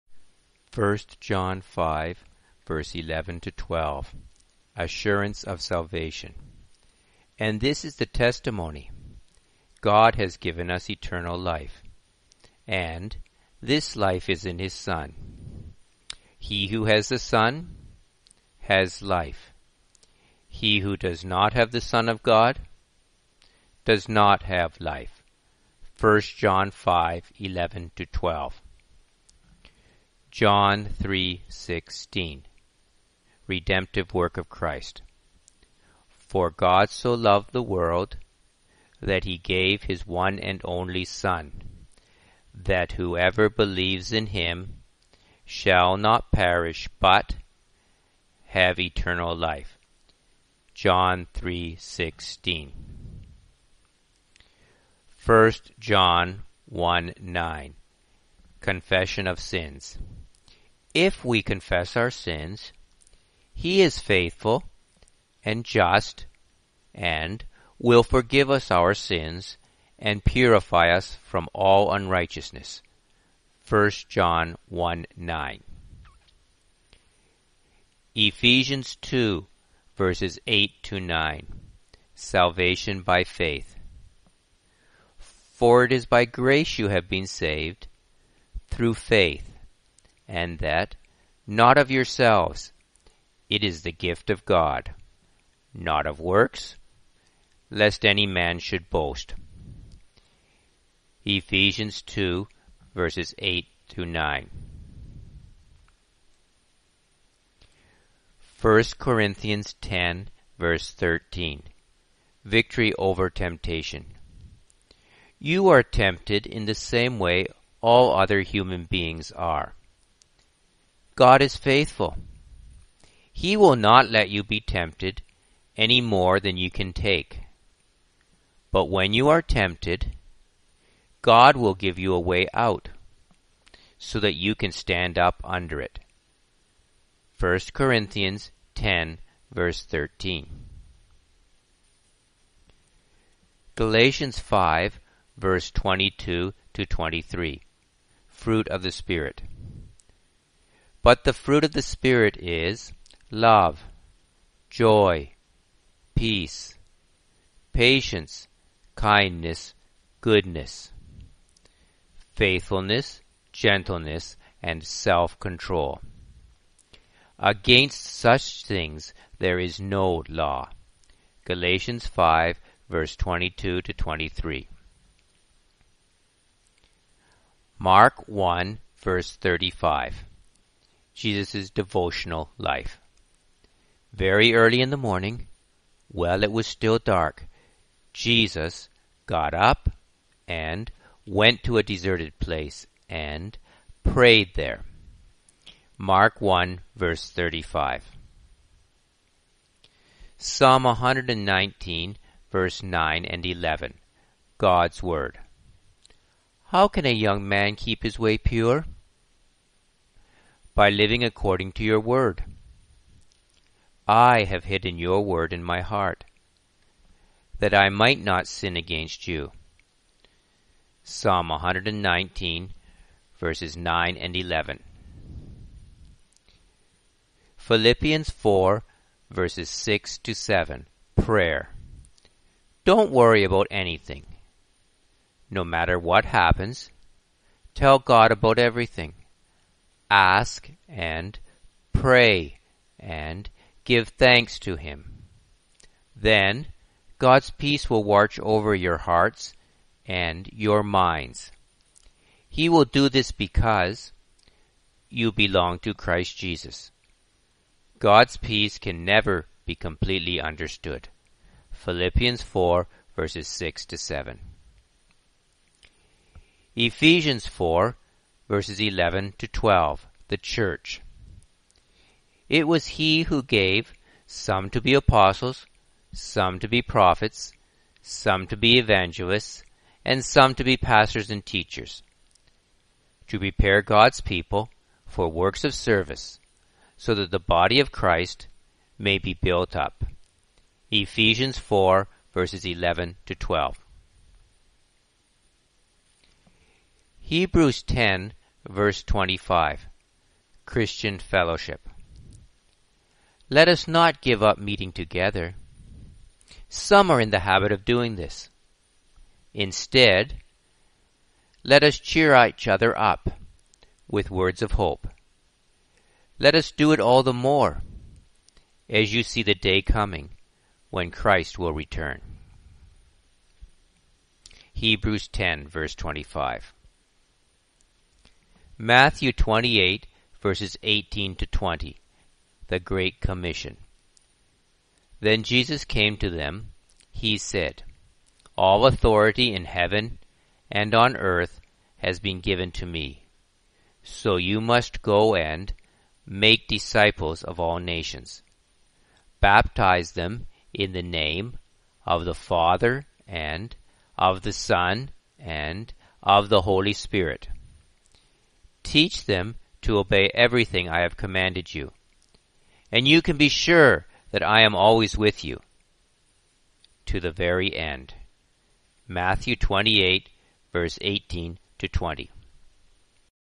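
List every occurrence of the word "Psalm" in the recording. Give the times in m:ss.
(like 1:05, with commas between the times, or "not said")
3:20, 3:41.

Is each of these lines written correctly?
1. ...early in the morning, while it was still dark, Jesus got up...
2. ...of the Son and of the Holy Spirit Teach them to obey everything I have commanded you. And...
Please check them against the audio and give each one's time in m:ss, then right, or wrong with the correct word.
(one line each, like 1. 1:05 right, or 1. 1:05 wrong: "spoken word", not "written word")
1. 3:04 right
2. 5:54 right.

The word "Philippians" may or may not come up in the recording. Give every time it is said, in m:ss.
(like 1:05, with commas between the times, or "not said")
3:47, 4:21.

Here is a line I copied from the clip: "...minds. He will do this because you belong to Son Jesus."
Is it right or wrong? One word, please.
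wrong.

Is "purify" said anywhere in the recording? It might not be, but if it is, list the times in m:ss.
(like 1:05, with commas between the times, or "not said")
1:10.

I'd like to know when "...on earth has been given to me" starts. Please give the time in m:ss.
5:40.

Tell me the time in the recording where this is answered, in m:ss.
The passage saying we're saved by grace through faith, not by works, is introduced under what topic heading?
1:22.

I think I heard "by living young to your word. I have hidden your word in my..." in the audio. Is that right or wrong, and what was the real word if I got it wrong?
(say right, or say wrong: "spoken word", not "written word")
wrong: "according", not "young".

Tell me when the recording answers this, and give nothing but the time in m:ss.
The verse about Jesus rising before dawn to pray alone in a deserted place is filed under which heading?
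3:01.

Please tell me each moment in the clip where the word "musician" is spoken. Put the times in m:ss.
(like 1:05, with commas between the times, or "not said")
not said.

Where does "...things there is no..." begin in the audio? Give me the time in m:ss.
2:48.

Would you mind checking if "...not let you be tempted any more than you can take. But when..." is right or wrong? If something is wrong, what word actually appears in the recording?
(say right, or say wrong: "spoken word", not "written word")
right.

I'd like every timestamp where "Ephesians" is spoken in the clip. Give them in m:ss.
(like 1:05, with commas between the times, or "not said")
1:18, 1:41, 4:26, 4:50.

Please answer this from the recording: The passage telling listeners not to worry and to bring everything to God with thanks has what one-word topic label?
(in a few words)
Prayer.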